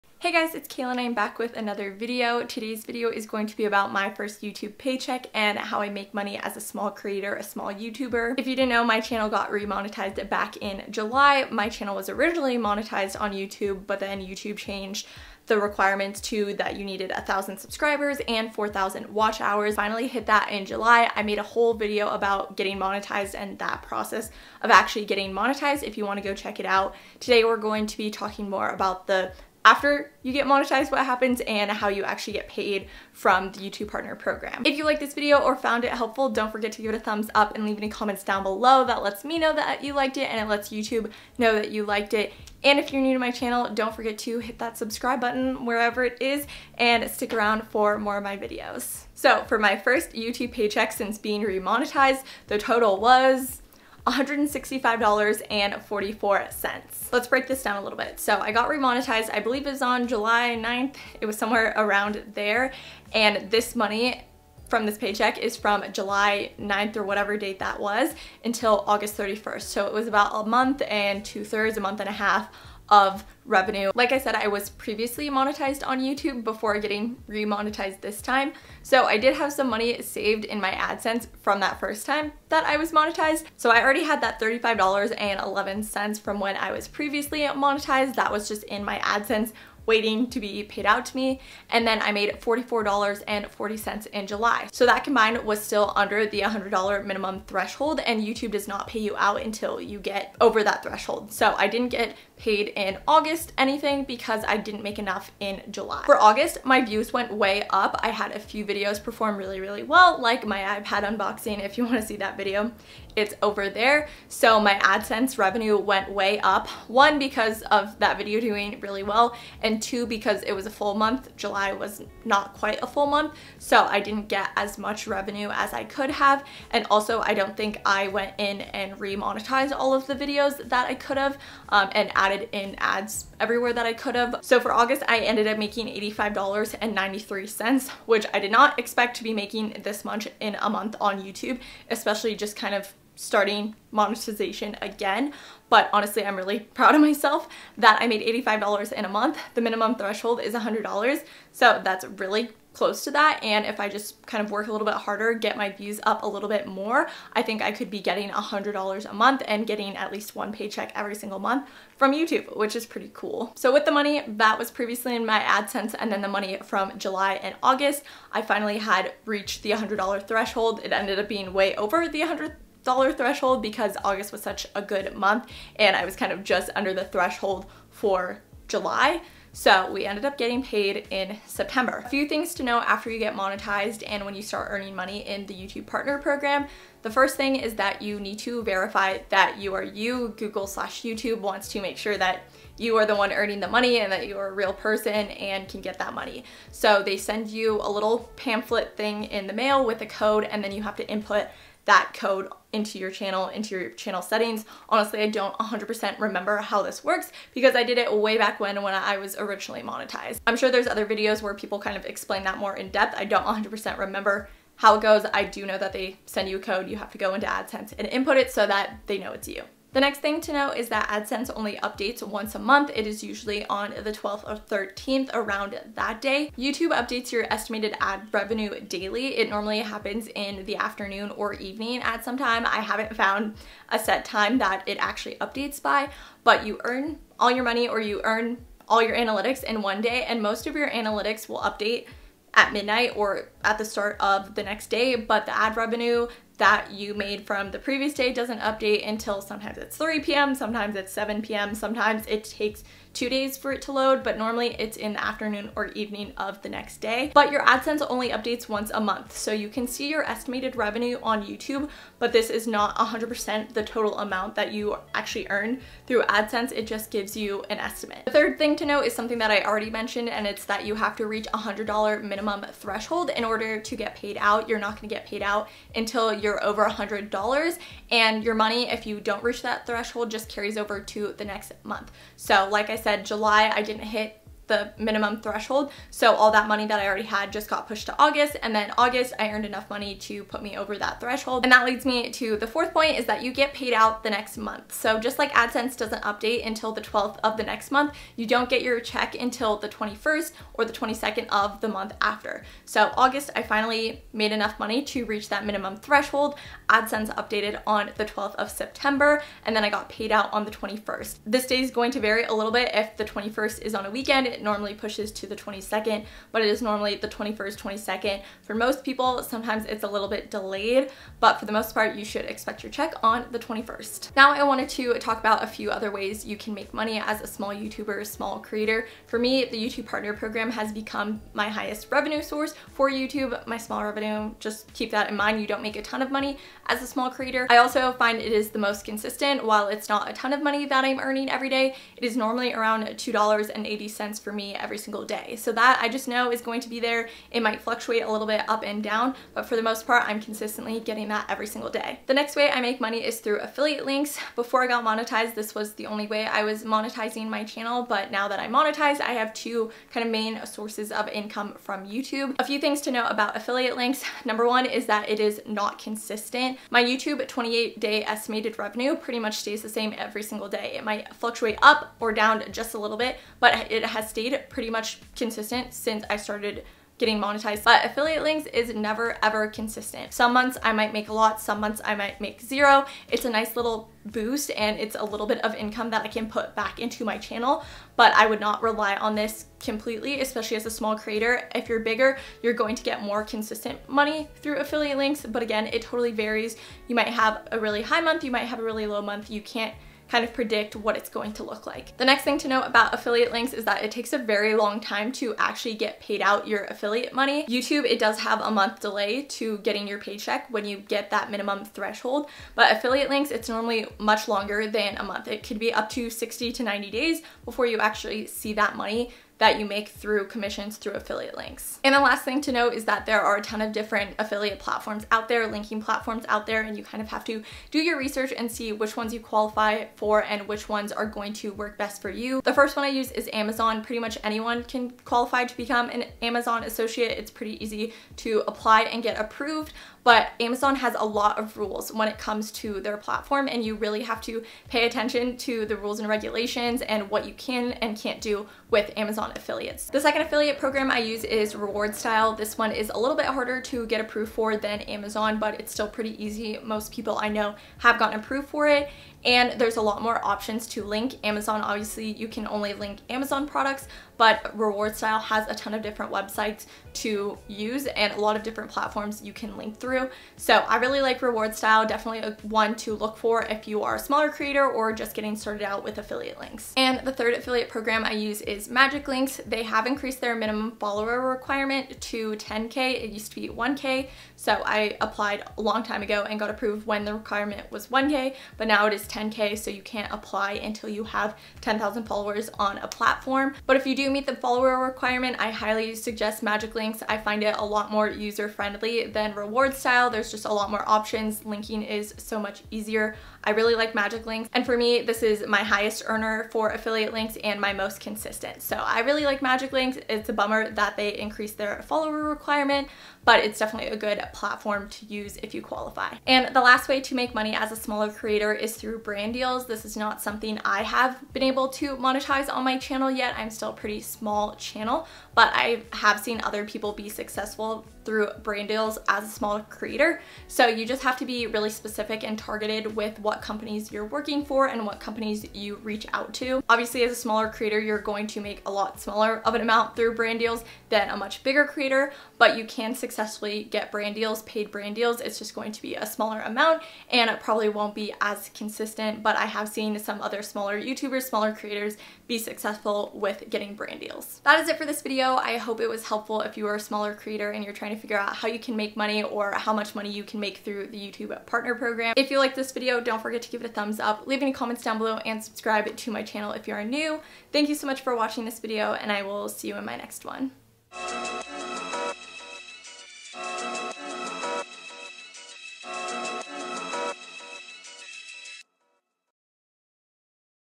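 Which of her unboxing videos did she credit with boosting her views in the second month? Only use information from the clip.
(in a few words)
iPad unboxing.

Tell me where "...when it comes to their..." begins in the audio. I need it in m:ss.
7:22.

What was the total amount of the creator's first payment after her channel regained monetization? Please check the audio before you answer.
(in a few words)
$165.44.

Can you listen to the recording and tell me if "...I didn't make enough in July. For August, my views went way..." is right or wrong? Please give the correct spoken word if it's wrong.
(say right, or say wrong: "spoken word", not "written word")
right.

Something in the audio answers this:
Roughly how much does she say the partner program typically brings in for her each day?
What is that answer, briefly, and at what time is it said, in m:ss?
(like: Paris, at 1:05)
$2.80, at 5:43.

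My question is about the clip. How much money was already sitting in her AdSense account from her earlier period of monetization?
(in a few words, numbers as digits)
$35.11.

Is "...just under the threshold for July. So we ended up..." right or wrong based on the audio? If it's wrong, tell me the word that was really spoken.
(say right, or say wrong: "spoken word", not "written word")
right.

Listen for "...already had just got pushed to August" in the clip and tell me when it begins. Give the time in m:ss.
4:47.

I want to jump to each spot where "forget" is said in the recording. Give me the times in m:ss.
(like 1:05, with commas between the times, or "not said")
0:36, 0:43, 9:23.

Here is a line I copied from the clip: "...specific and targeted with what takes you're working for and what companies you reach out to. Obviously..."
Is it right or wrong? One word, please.
wrong.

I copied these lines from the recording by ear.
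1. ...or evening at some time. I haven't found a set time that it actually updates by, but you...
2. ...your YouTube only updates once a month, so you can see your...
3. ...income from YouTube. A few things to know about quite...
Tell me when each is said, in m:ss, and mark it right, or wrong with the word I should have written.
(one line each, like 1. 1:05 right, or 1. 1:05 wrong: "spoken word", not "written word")
1. 3:51 right
2. 4:17 wrong: "AdSense", not "YouTube"
3. 6:01 wrong: "affiliate", not "quite".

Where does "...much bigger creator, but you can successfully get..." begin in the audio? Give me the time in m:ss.
9:01.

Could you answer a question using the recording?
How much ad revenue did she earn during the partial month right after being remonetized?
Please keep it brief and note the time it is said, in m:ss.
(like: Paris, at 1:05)
$44.40, at 1:32.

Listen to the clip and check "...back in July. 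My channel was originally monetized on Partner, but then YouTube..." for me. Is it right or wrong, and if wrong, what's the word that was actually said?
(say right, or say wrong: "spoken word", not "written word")
wrong: "YouTube", not "Partner".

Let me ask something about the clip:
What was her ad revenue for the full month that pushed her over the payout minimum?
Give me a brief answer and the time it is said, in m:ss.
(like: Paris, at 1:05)
$85.93, at 2:15.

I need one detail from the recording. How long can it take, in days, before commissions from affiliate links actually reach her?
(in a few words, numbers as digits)
60 to 90 days.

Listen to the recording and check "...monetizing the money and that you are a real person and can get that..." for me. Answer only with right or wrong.
wrong.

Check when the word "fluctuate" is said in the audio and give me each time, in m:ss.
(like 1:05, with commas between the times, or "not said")
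5:47, 6:11.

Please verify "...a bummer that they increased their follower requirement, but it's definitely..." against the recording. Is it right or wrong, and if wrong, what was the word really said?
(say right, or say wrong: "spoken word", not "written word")
right.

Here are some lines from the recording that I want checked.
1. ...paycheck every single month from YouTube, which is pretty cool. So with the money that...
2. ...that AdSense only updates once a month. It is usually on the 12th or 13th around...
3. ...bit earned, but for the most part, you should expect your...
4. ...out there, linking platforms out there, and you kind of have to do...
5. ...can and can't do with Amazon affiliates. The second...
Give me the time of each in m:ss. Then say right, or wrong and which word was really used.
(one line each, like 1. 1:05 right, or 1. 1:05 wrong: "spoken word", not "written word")
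1. 2:40 right
2. 3:40 right
3. 5:20 wrong: "delayed", not "earned"
4. 7:05 right
5. 7:27 right.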